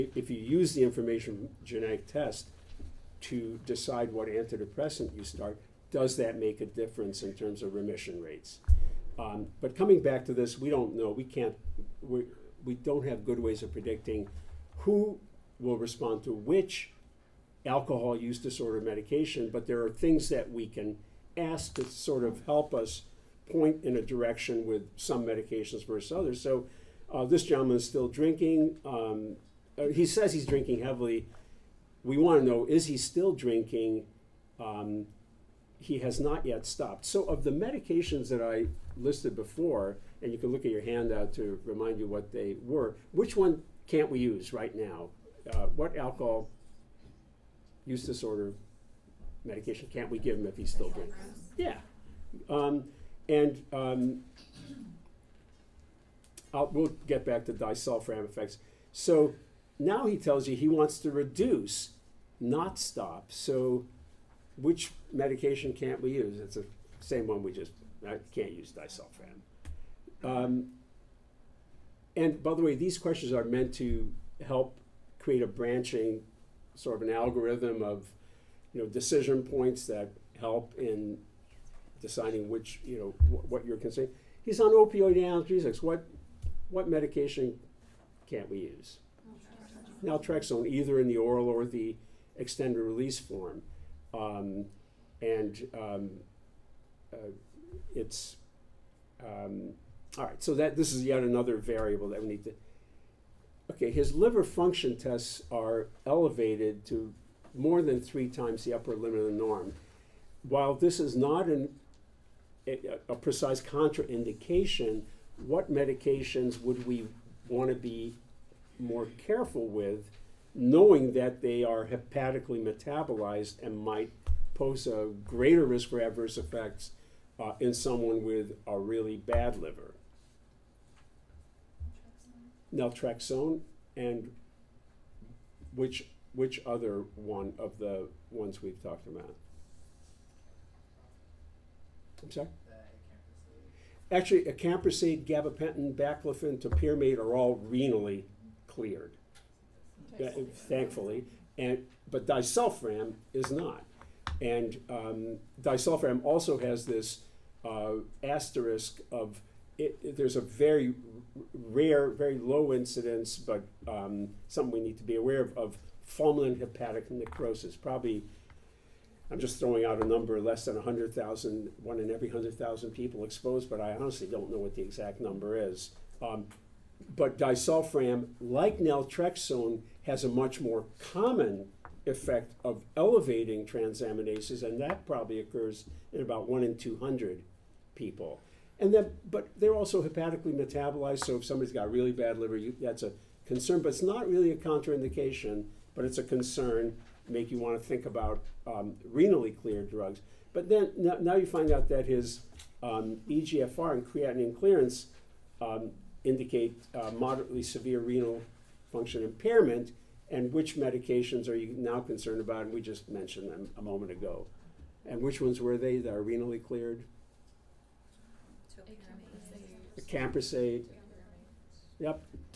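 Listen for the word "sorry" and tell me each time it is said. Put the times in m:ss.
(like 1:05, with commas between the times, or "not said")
2:22.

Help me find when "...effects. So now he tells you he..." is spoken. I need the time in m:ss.
0:58.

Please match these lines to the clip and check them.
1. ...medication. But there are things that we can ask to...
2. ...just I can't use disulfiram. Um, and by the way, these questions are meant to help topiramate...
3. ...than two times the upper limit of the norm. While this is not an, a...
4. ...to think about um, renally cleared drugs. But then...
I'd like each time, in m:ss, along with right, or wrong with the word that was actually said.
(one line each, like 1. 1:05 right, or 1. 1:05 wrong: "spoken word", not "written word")
1. 0:18 right
2. 1:07 wrong: "create", not "topiramate"
3. 1:47 wrong: "three", not "two"
4. 3:17 right.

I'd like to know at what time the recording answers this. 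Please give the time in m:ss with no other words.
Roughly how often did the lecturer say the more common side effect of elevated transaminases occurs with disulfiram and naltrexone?
3:06.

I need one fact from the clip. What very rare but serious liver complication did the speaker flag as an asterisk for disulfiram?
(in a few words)
Fulminant hepatic necrosis.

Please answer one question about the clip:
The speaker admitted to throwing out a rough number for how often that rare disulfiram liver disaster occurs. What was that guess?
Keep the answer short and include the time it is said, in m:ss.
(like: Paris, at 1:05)
1 in 100,000, at 2:51.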